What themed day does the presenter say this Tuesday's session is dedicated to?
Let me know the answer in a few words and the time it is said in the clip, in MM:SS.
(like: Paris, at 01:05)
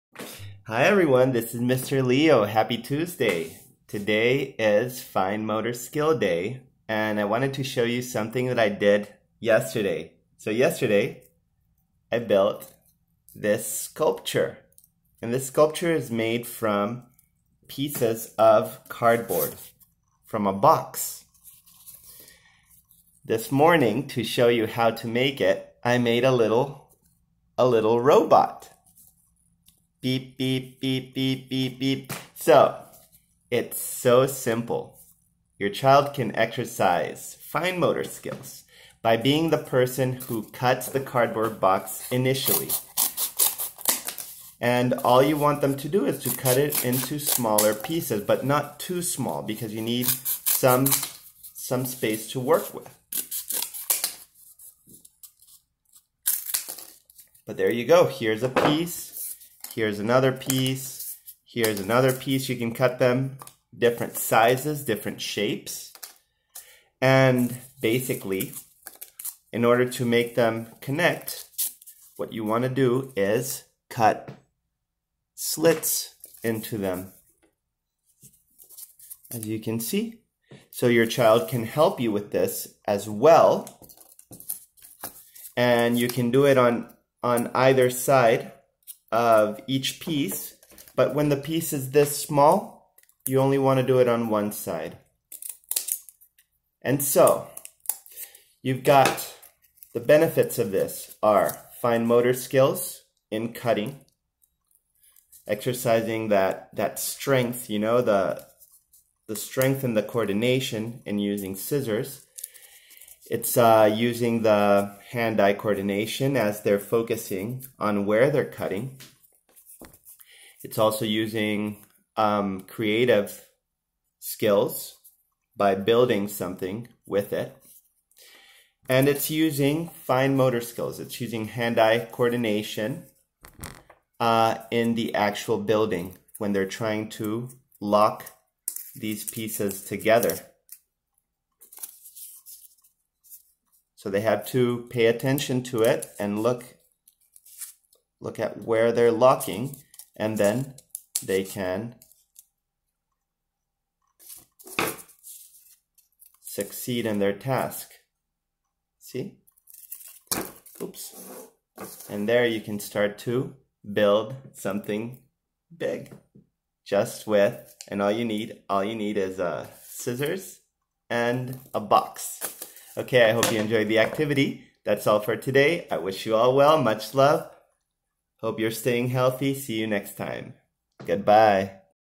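Fine Motor Skill Day, at 00:05.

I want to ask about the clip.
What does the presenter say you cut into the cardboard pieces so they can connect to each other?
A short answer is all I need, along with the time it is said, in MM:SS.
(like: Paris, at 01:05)
slits, at 01:15.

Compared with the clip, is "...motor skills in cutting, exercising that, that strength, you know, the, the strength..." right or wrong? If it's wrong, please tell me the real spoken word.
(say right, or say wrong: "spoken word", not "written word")
right.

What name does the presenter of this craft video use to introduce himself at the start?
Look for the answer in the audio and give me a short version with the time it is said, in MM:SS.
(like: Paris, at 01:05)
Mr. Lio, at 00:01.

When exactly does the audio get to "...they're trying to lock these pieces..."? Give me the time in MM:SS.
02:16.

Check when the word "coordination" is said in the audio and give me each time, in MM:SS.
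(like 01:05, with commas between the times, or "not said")
01:50, 01:55, 02:12.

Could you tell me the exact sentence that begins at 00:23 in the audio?
This morning, to show you how to make it, I made a little, a little robot.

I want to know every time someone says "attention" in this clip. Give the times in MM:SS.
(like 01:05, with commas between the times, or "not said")
02:25.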